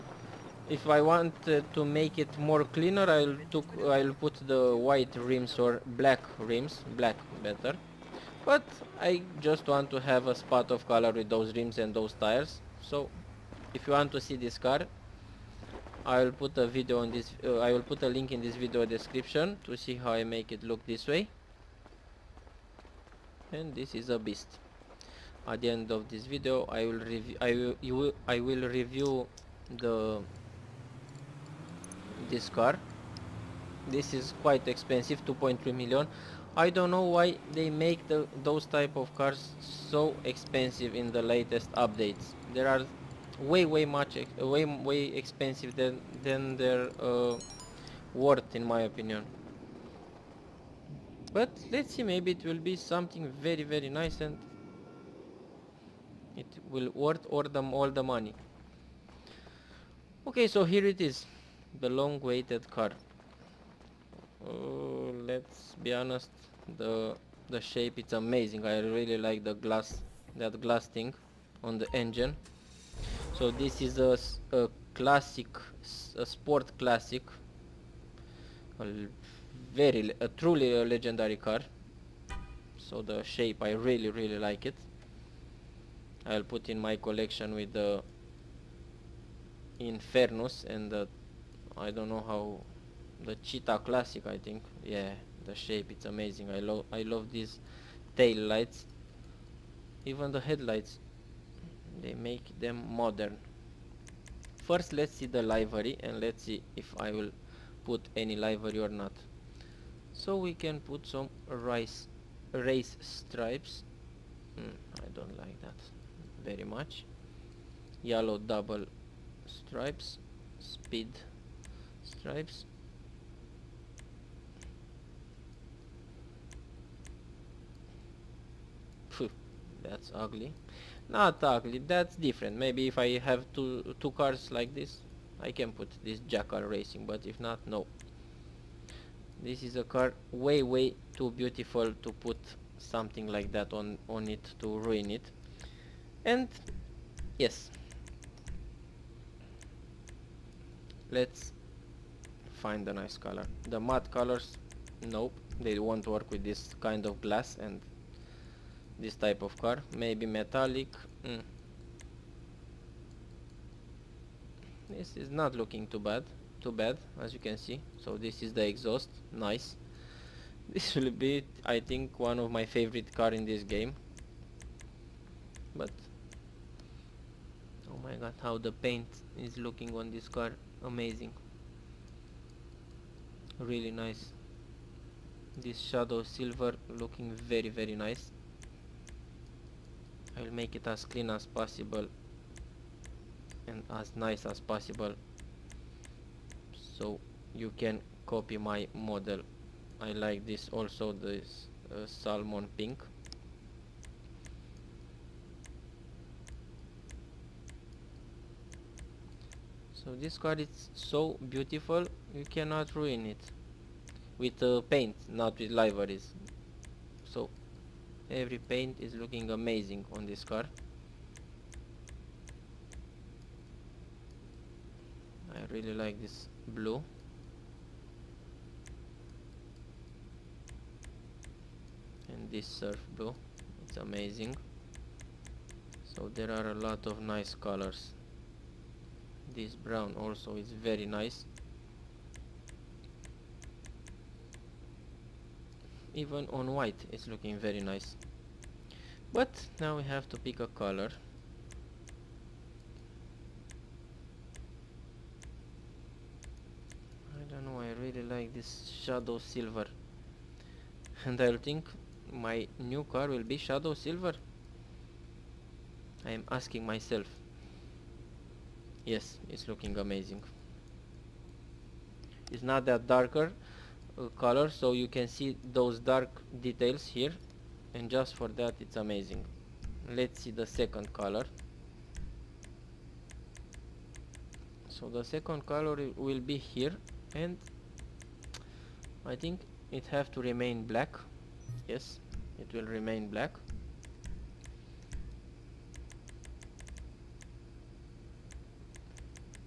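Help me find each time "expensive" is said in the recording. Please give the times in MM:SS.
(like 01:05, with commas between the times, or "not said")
00:34, 00:40, 00:45.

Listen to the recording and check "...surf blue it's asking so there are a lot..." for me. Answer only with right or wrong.
wrong.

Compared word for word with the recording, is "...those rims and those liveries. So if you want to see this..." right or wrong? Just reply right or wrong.
wrong.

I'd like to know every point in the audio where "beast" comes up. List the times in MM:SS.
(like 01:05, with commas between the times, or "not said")
00:24.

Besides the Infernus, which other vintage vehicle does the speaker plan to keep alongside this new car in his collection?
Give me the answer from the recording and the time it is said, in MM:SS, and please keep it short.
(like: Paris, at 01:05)
Cheetah Classic, at 01:33.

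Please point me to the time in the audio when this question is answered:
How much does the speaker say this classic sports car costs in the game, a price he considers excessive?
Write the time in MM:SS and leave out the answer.
00:35.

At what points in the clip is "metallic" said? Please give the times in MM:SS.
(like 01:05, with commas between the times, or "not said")
02:40.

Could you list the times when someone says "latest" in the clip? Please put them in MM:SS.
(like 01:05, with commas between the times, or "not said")
00:41.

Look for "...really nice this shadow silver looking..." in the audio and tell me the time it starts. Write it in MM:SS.
03:03.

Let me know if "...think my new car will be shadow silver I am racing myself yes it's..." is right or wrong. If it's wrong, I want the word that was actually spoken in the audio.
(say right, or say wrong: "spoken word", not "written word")
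wrong: "asking", not "racing".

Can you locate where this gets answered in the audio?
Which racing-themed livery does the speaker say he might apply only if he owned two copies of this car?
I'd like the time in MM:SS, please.
02:16.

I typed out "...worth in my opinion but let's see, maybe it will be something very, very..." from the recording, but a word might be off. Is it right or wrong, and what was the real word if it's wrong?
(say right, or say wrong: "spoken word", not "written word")
right.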